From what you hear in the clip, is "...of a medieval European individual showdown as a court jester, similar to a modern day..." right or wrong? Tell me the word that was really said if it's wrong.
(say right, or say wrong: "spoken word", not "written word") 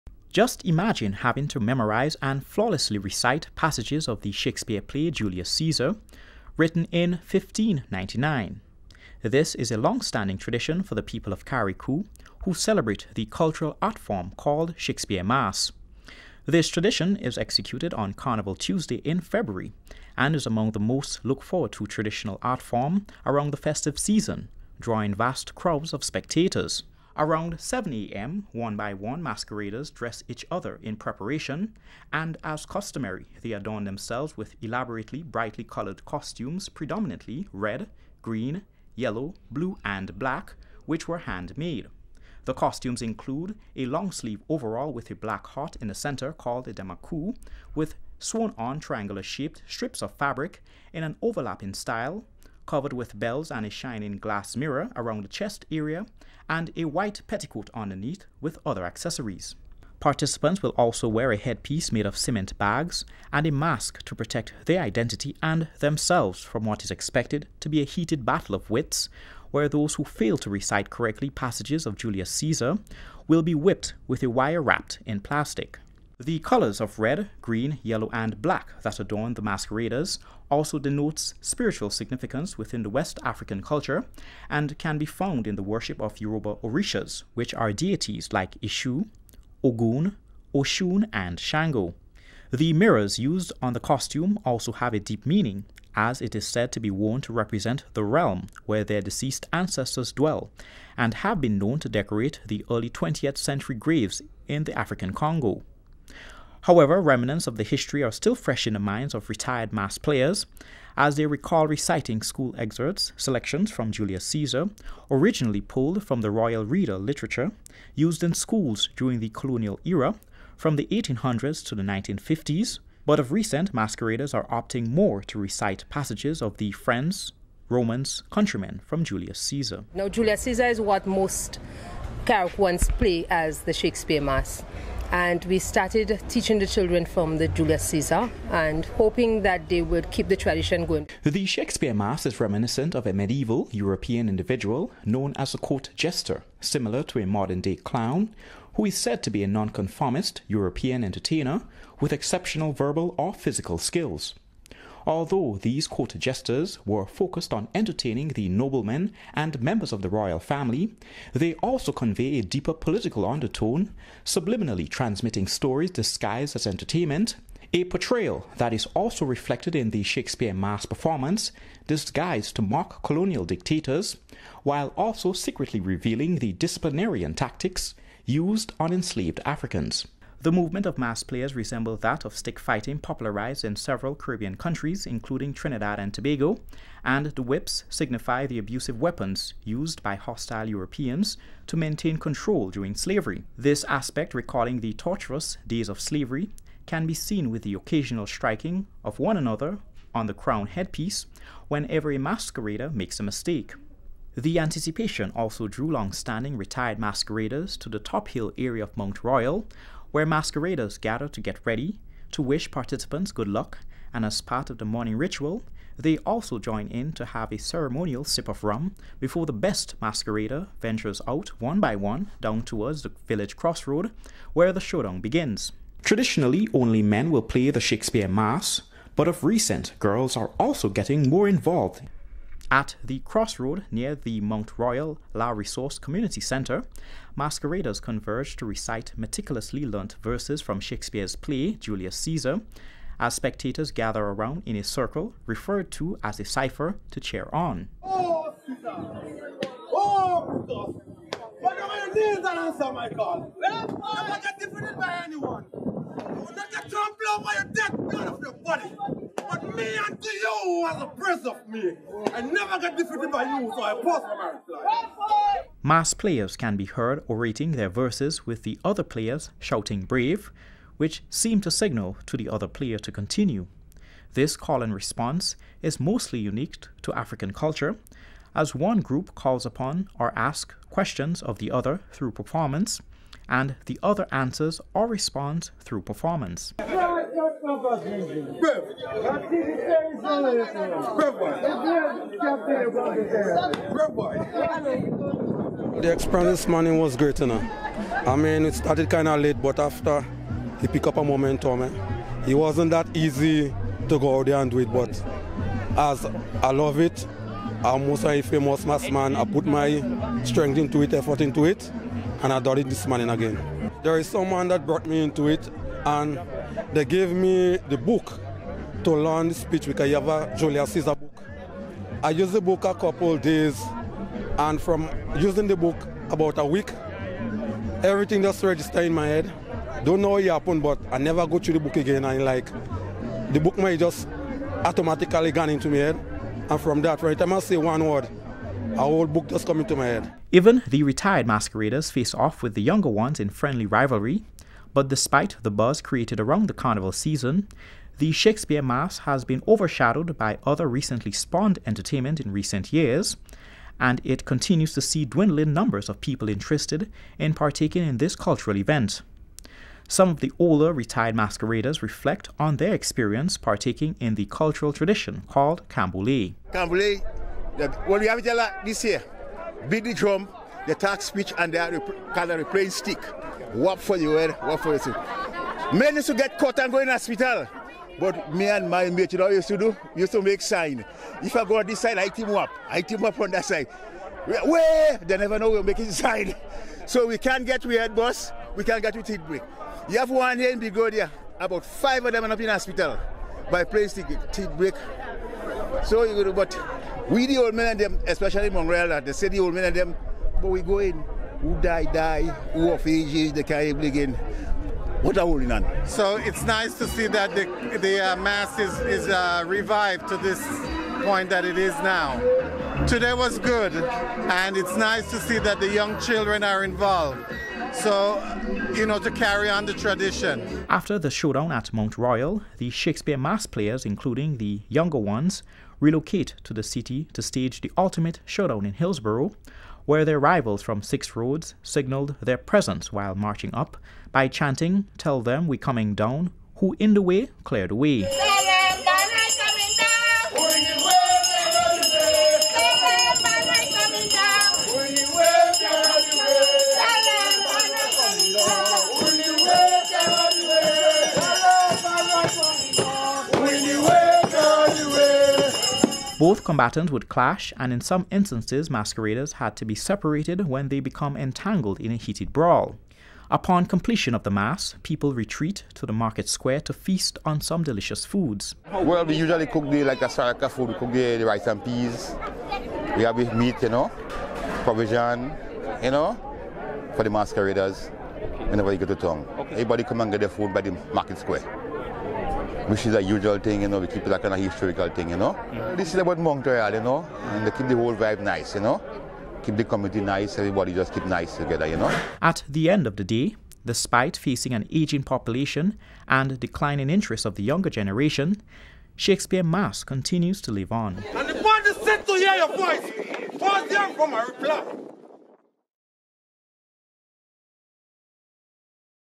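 wrong: "known", not "showdown".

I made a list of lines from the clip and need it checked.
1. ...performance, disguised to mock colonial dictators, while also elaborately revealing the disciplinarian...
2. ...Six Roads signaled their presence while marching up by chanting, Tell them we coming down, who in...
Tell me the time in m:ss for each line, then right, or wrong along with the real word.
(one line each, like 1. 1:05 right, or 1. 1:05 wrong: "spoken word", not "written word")
1. 2:50 wrong: "secretly", not "elaborately"
2. 7:11 right.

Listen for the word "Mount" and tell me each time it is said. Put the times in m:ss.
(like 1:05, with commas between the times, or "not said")
3:28, 3:54, 7:01.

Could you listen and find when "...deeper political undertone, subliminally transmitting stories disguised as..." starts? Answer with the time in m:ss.
2:42.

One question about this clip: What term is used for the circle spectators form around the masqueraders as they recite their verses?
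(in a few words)
cipher.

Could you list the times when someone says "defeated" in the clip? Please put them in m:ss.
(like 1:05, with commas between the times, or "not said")
4:14, 4:22.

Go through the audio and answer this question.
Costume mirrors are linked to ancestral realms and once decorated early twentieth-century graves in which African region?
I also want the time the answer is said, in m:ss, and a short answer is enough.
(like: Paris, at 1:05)
Congo, at 1:44.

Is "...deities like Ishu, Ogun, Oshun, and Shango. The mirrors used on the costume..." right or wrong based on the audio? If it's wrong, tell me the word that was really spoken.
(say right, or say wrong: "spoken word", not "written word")
right.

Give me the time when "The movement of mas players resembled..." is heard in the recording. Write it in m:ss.
3:00.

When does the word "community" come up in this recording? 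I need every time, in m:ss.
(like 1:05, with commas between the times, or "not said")
3:55, 8:09.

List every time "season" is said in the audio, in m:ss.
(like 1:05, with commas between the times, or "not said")
0:23, 5:47.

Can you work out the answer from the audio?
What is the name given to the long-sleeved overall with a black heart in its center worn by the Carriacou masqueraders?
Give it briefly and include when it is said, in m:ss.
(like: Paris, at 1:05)
demaku, at 0:46.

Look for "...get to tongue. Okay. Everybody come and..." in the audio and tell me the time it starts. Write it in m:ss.
7:59.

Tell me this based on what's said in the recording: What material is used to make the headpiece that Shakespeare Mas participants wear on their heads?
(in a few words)
cement bags.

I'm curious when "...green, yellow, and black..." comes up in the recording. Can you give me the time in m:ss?
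1:17.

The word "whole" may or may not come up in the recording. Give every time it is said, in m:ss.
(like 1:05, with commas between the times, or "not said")
5:39, 8:07.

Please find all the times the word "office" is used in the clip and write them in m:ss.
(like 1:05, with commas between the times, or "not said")
not said.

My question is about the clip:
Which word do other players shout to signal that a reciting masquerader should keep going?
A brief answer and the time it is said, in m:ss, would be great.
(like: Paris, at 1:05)
brave, at 4:30.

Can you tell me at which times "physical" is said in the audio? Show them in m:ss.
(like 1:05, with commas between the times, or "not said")
2:33.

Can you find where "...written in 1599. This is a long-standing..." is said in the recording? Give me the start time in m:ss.
0:06.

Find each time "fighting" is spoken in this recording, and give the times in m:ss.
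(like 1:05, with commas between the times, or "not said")
3:02.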